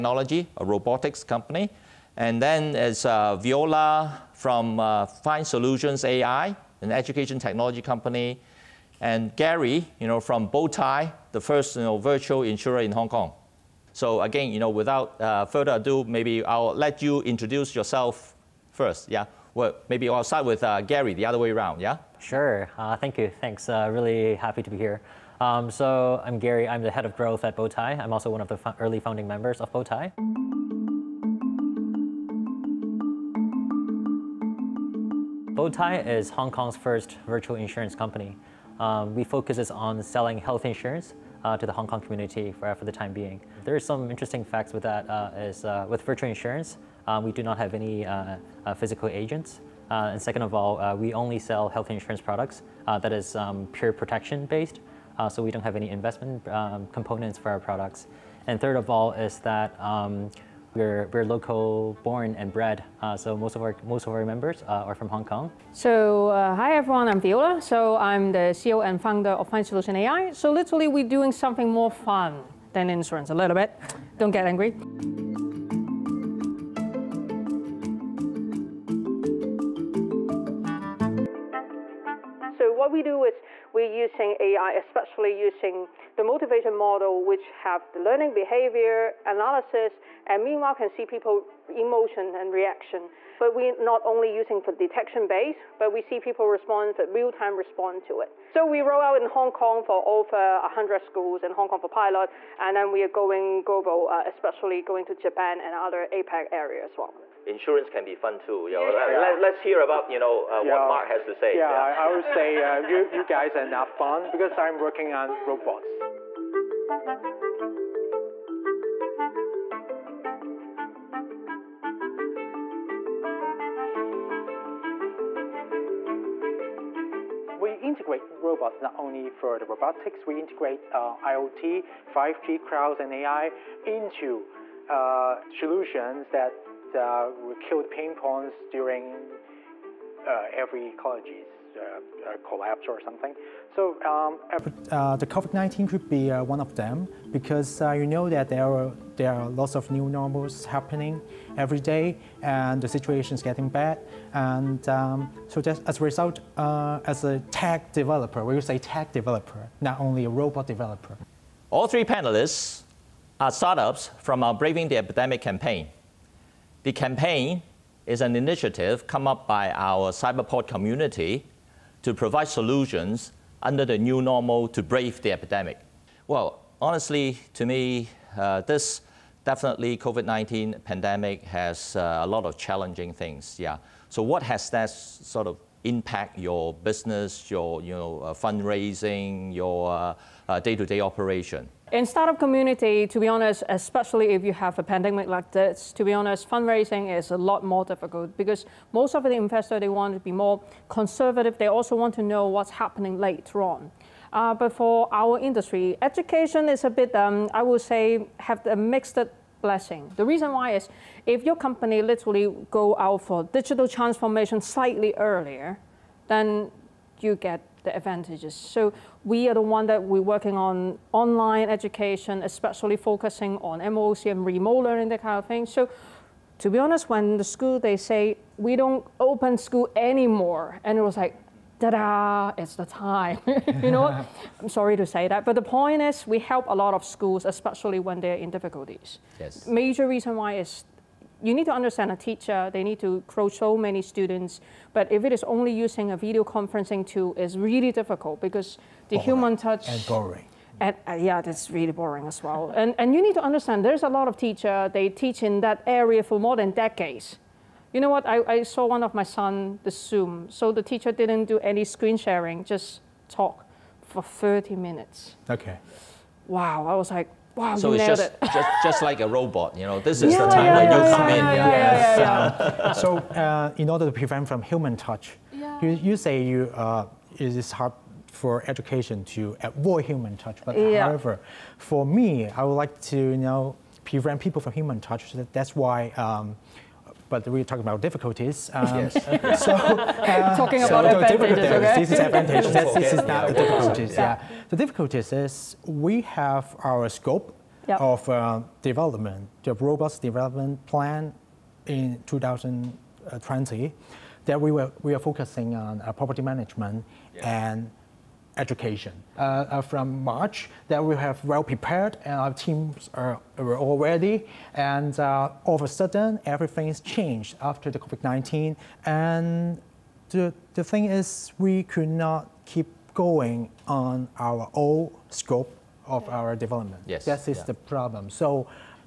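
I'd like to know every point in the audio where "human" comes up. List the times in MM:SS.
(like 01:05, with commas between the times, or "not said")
04:09, 04:34, 04:40, 04:44.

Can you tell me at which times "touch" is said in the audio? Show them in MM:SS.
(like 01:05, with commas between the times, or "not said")
04:09, 04:34, 04:40, 04:45.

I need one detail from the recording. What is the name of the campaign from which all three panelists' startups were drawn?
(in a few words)
Braving the Epidemic.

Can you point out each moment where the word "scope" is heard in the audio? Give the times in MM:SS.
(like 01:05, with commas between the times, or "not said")
04:57, 05:25.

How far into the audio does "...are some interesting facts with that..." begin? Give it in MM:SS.
00:43.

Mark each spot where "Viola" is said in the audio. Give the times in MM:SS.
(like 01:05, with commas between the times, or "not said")
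00:03, 01:07.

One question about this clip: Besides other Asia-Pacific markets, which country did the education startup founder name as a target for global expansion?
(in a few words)
Japan.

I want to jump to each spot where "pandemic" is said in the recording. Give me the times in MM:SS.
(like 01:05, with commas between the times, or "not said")
03:00, 03:14.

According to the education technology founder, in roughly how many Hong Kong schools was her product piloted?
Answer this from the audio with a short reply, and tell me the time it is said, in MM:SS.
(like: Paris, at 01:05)
Over 100, at 01:40.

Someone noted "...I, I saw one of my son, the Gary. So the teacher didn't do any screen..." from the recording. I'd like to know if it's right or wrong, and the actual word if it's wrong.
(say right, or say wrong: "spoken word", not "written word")
wrong: "Zoom", not "Gary".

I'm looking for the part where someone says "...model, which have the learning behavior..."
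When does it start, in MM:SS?
01:26.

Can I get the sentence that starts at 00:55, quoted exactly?
so we don't have any investment um, components for our products.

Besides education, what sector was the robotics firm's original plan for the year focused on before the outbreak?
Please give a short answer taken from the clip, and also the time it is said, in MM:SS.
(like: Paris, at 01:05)
Property management, at 05:06.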